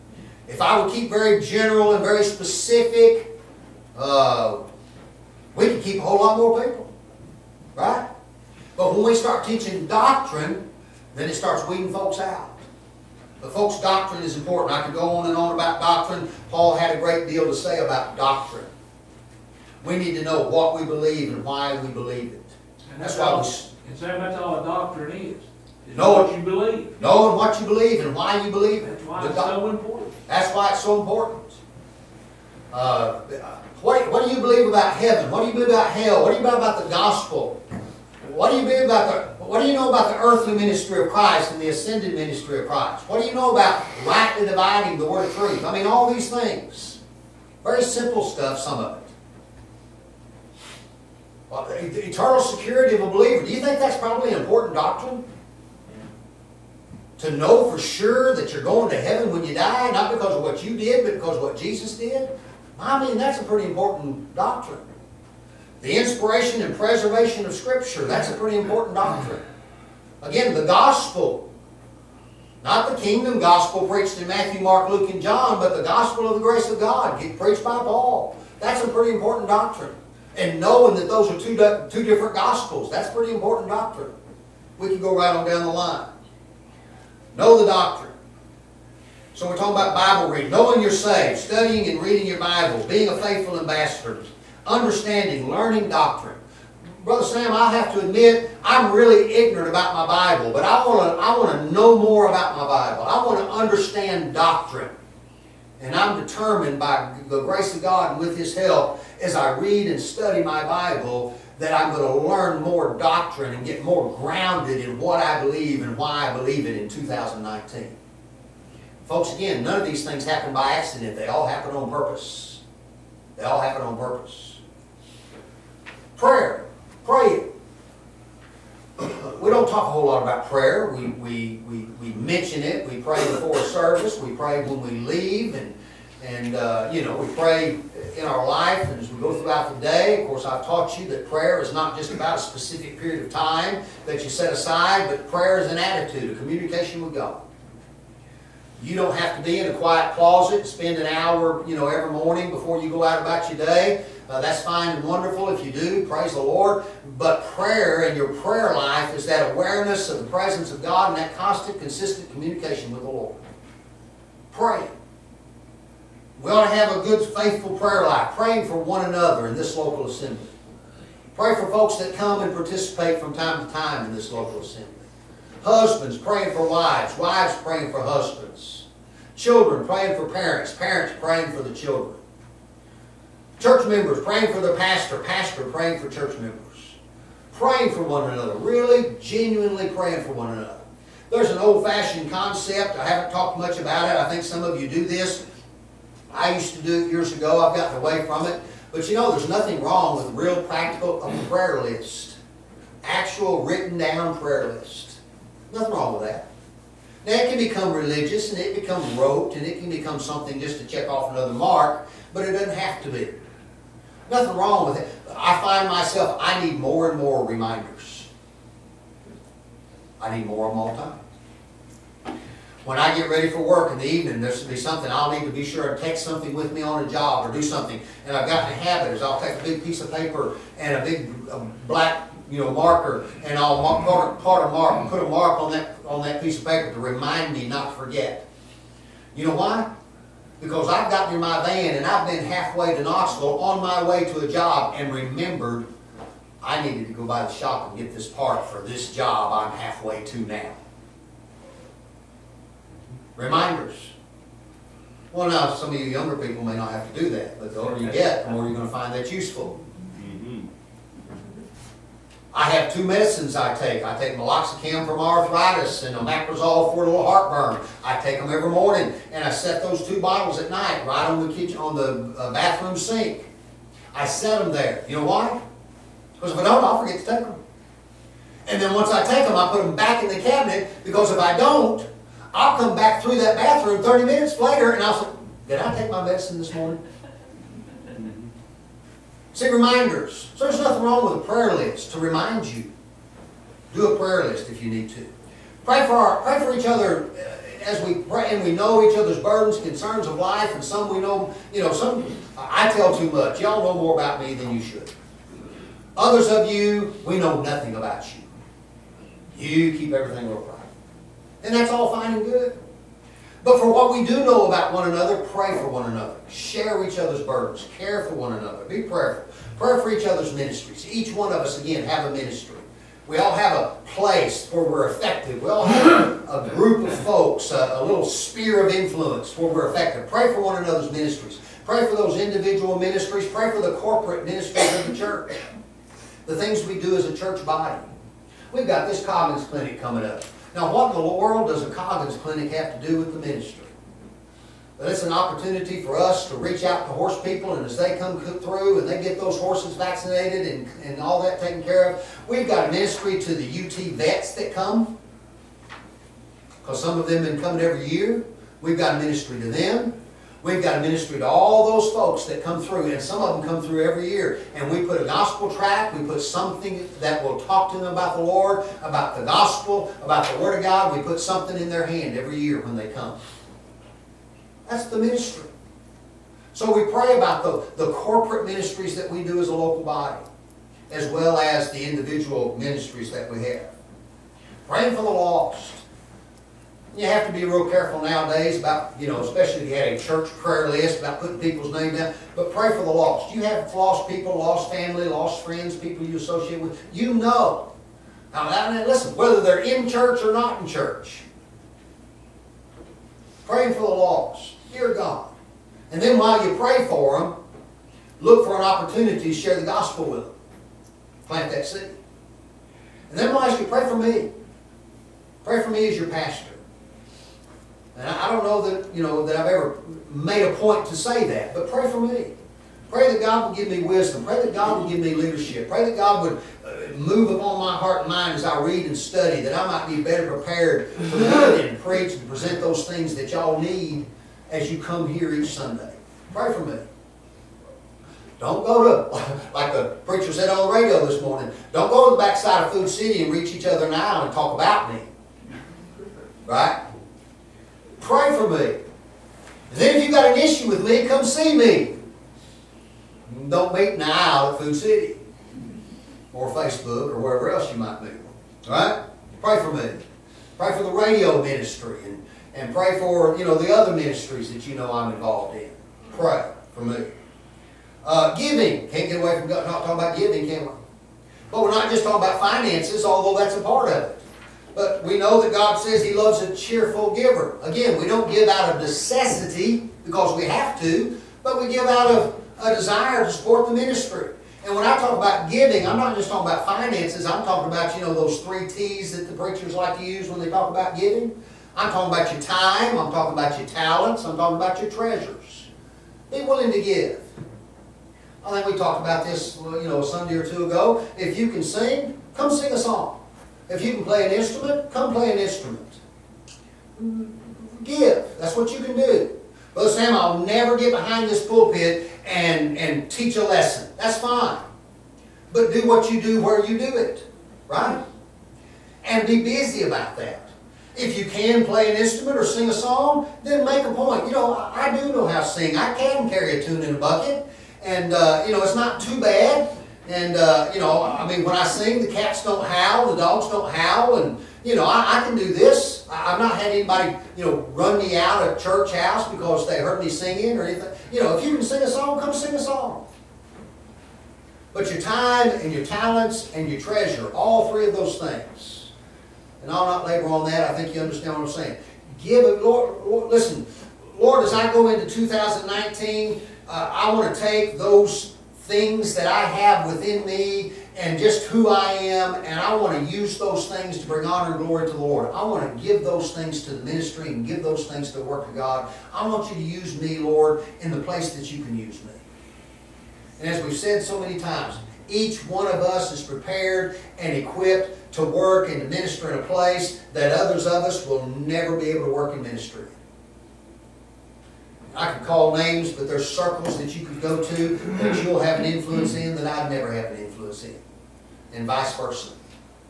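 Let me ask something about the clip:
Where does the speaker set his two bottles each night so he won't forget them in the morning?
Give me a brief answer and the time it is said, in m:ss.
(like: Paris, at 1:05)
bathroom sink, at 4:32.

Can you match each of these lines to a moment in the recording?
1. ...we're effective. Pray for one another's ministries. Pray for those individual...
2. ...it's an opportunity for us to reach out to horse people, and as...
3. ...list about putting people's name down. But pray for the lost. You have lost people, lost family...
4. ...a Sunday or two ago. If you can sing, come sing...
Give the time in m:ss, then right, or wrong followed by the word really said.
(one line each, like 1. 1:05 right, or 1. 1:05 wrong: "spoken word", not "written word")
1. 5:29 right
2. 5:45 right
3. 6:30 right
4. 8:20 right.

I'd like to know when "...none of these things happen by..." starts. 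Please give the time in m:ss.
1:59.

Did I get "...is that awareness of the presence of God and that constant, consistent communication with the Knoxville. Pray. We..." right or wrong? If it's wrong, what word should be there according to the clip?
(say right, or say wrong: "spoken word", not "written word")
wrong: "Lord", not "Knoxville".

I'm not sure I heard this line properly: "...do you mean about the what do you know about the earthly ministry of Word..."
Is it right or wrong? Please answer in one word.
wrong.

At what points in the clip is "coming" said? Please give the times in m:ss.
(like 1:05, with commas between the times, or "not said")
5:39, 5:57.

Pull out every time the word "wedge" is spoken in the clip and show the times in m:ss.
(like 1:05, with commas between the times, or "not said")
not said.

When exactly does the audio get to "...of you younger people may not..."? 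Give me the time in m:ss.
4:15.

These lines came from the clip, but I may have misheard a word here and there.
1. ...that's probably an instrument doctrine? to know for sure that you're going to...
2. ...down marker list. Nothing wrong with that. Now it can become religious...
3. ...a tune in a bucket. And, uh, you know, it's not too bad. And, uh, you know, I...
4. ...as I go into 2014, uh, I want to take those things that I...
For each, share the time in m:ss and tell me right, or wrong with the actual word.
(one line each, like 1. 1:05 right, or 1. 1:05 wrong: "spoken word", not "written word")
1. 0:53 wrong: "important", not "instrument"
2. 3:23 wrong: "prayer", not "marker"
3. 8:46 right
4. 9:14 wrong: "2019", not "2014".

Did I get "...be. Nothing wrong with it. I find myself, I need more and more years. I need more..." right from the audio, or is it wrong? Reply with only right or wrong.
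wrong.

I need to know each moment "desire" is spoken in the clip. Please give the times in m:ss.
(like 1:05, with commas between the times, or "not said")
8:02.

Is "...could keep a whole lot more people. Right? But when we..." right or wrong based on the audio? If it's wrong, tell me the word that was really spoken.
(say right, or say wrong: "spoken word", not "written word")
right.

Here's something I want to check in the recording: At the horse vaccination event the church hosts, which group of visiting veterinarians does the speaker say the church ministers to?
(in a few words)
UT vets.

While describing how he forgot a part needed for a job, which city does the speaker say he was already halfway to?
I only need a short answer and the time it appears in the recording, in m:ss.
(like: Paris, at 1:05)
Knoxville, at 4:03.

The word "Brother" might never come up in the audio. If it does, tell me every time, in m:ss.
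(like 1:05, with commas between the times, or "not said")
1:37, 8:29.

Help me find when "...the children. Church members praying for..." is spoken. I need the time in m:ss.
3:01.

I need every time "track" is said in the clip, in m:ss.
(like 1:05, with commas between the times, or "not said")
6:05.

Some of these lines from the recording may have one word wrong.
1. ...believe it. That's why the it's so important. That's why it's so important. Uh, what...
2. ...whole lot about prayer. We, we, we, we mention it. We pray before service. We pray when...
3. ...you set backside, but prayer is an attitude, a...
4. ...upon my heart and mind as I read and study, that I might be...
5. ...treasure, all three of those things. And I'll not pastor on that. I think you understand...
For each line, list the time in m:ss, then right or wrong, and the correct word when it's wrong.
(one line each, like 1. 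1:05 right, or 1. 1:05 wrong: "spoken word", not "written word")
1. 0:28 right
2. 2:09 right
3. 2:24 wrong: "aside", not "backside"
4. 7:07 right
5. 9:06 wrong: "labor", not "pastor".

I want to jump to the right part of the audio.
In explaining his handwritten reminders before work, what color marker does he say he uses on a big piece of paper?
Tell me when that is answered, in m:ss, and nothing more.
3:51.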